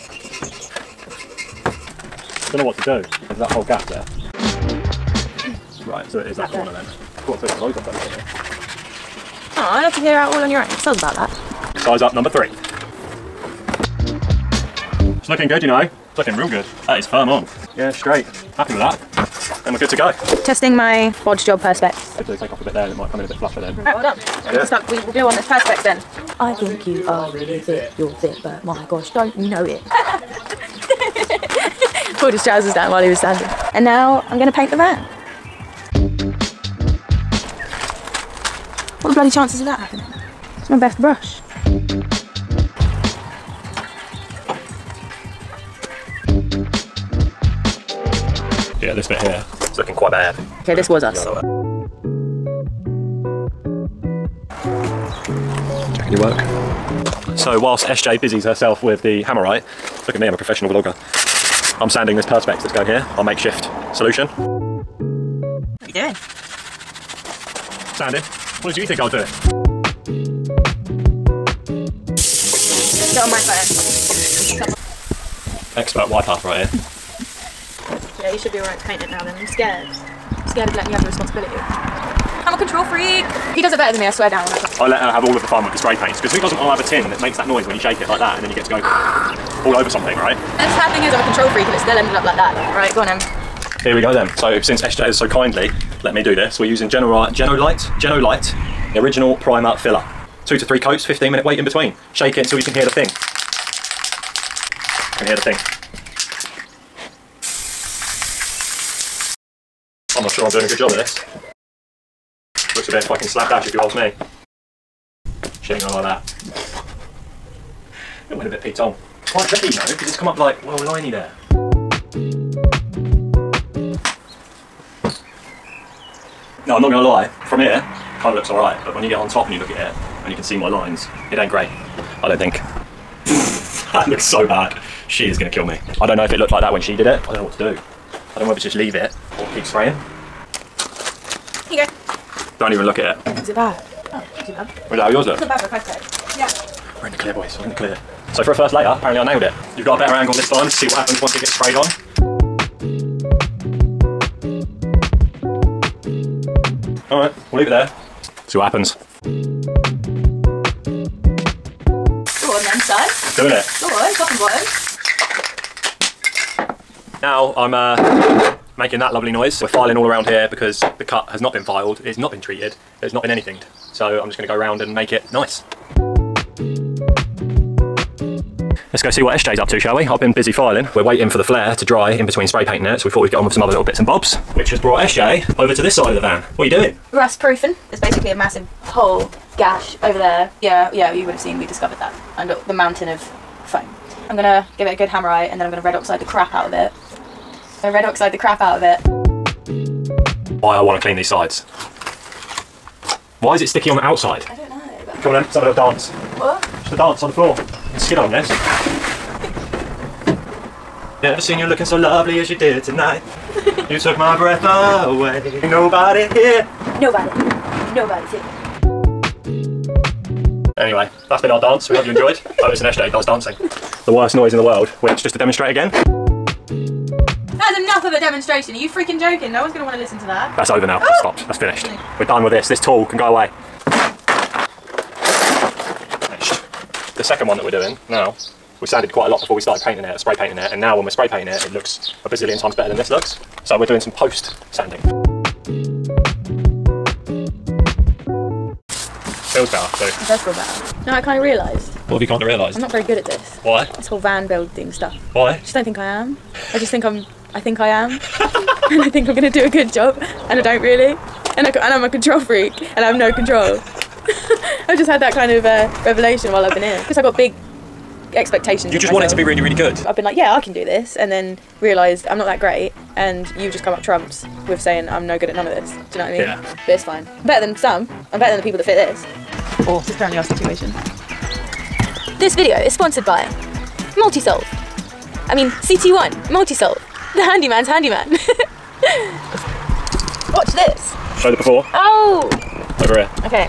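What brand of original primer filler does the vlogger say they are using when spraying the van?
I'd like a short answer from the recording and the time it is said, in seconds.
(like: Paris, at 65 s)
Genolite, at 98 s.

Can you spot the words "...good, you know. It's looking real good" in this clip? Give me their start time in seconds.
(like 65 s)
15 s.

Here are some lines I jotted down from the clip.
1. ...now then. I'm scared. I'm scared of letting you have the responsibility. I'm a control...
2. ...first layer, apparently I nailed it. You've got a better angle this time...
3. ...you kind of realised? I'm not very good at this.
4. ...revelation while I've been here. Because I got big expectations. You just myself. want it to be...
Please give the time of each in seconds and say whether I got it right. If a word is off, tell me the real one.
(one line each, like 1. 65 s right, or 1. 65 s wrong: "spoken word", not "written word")
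1. 79 s right
2. 148 s right
3. 252 s right
4. 266 s right.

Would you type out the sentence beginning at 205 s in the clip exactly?
Come on in, let's have a little dance.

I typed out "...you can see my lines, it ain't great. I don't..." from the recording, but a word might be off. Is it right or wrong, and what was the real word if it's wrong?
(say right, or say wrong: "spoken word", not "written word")
right.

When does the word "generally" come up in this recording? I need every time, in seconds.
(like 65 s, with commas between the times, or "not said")
not said.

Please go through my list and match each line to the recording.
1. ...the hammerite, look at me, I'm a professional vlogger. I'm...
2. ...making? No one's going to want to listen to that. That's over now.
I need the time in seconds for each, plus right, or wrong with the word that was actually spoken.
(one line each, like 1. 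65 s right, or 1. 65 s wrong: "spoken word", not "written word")
1. 59 s right
2. 229 s wrong: "joking", not "making".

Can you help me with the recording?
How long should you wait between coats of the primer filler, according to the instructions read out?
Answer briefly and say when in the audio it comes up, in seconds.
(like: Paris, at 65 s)
15 minutes, at 101 s.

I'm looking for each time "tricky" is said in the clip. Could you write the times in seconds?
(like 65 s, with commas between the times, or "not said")
119 s.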